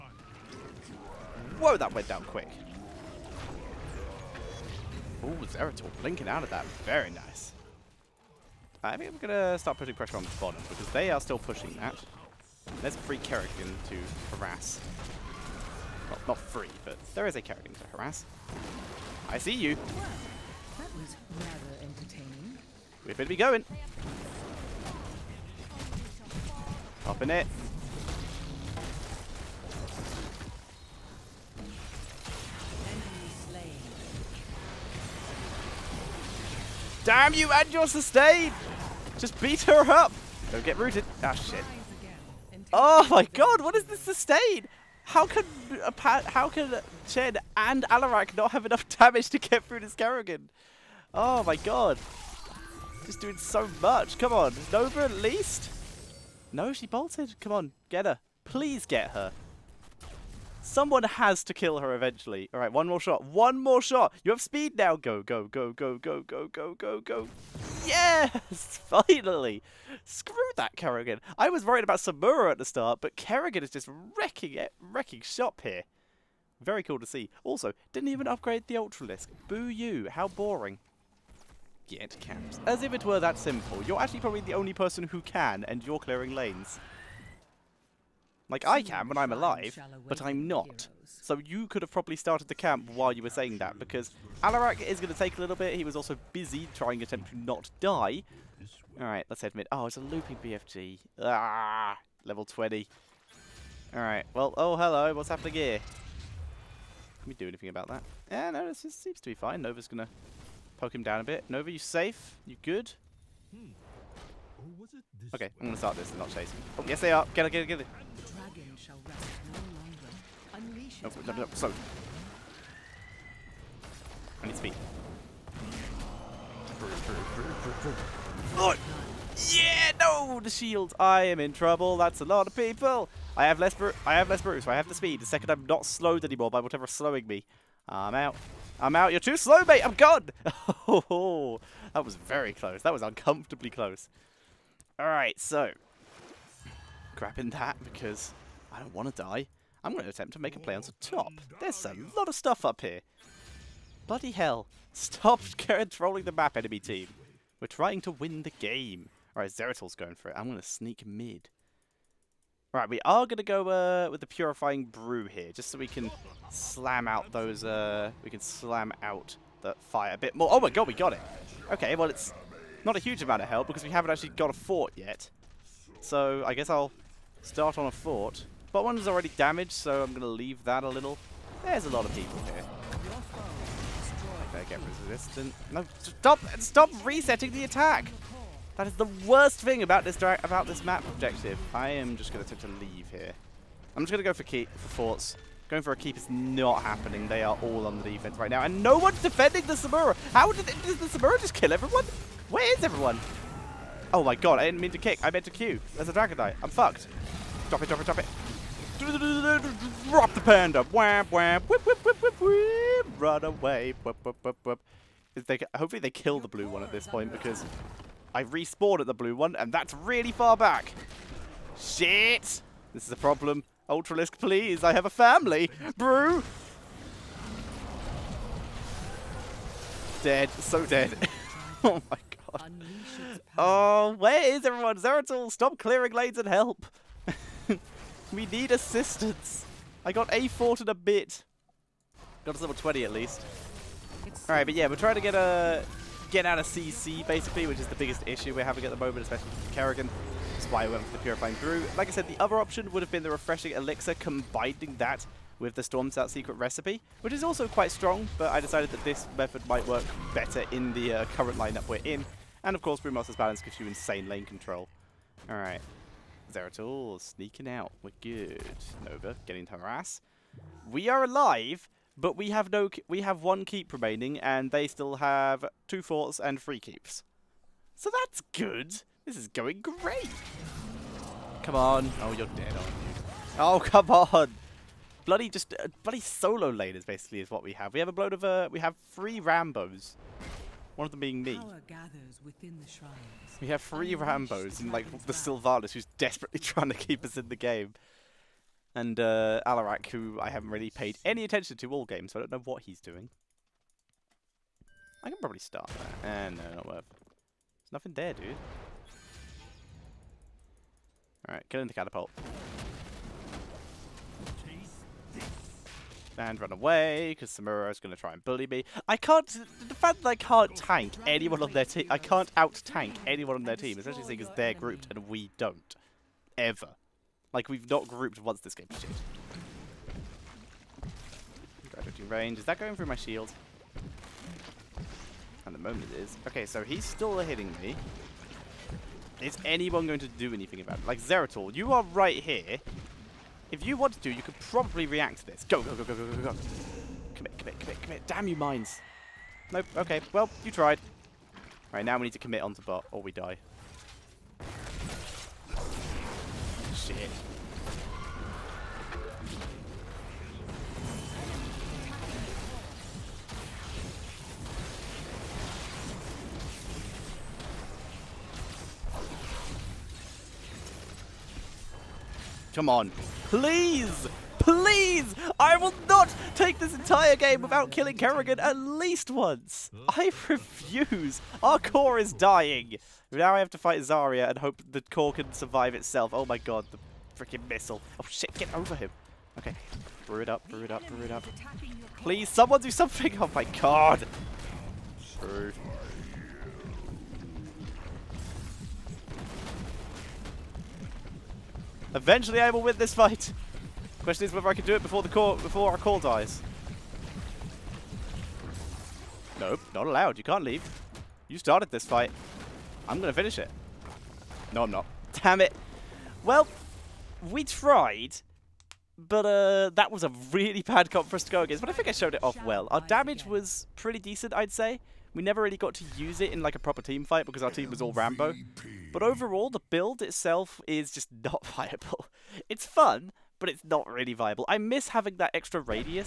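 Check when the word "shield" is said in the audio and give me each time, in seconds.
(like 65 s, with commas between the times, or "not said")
130 s, 333 s.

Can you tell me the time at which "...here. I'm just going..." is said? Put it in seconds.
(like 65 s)
193 s.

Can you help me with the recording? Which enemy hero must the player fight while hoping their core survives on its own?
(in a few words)
Zarya.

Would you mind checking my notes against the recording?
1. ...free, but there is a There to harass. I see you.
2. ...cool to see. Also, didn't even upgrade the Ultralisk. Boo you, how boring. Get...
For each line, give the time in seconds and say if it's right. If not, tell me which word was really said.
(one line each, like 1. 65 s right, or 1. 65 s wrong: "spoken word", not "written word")
1. 16 s wrong: "Kerrigan", not "There"
2. 76 s right.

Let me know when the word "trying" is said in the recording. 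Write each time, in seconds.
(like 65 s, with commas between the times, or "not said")
96 s, 157 s, 244 s, 296 s.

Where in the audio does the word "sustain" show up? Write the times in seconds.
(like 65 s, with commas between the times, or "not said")
37 s, 43 s.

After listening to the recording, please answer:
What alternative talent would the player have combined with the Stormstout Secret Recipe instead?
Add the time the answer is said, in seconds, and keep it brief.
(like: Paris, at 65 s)
Refreshing Elixir, at 253 s.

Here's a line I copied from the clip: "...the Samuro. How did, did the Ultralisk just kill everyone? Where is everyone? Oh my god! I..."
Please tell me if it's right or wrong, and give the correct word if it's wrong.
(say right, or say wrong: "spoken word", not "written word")
wrong: "Samuro", not "Ultralisk".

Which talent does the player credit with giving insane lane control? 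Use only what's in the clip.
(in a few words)
Brewmaster's Balance.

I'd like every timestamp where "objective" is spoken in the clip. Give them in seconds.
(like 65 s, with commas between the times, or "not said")
191 s.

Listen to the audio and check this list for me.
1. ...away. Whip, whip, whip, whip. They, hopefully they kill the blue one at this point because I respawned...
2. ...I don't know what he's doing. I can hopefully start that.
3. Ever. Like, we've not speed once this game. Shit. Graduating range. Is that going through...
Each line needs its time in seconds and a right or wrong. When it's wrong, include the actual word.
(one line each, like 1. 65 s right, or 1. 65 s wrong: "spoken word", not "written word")
1. 213 s right
2. 302 s wrong: "probably", not "hopefully"
3. 326 s wrong: "grouped", not "speed".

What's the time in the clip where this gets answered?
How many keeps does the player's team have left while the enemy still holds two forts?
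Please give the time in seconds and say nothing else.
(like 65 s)
273 s.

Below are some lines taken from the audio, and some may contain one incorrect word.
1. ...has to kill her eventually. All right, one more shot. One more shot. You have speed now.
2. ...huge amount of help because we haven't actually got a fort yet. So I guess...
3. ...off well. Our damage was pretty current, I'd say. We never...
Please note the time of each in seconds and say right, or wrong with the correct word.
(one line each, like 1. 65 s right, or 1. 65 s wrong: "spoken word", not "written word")
1. 61 s right
2. 172 s right
3. 422 s wrong: "decent", not "current".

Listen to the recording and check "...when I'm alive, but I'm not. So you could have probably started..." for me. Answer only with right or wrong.
right.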